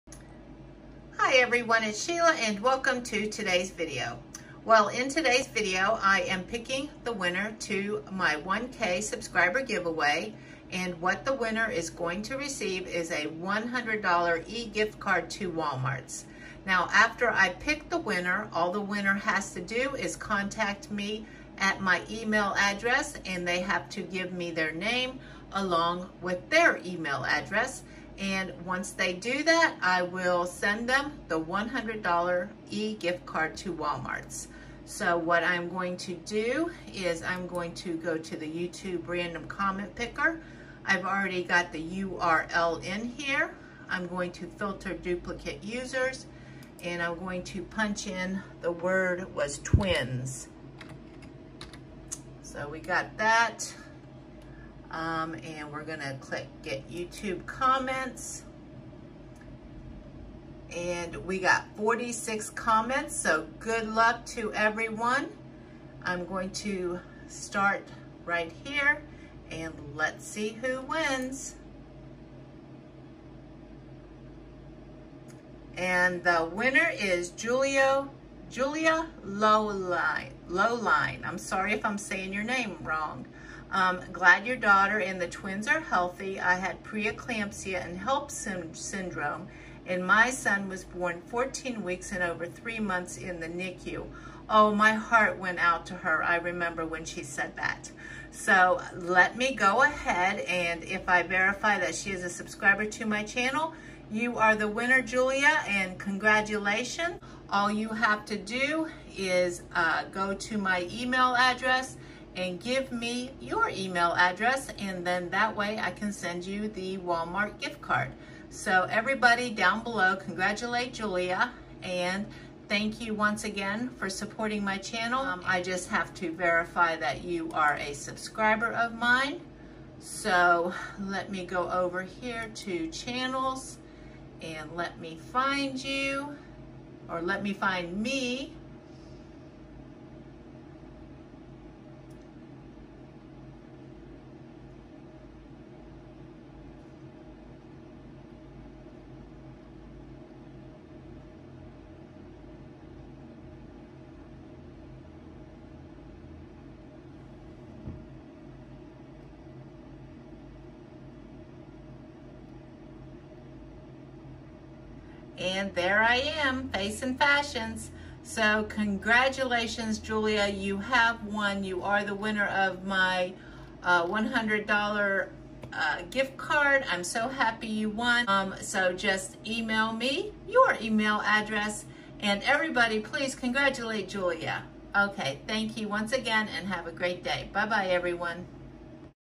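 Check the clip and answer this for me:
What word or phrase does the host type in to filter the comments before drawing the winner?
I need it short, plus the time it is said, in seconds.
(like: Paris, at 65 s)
was twins, at 49 s.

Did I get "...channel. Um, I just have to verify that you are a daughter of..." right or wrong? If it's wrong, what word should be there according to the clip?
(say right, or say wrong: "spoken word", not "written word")
wrong: "subscriber", not "daughter".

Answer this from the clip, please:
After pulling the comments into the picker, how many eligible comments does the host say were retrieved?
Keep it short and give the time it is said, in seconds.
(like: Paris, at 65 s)
46, at 61 s.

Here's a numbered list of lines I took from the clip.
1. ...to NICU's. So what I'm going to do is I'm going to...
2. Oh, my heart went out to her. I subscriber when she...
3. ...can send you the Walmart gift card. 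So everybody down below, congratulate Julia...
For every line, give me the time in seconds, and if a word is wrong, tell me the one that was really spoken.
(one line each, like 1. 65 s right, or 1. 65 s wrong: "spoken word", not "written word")
1. 33 s wrong: "Walmart", not "NICU"
2. 94 s wrong: "remember", not "subscriber"
3. 115 s right.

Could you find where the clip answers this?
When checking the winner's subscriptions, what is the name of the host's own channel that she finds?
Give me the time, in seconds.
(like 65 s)
166 s.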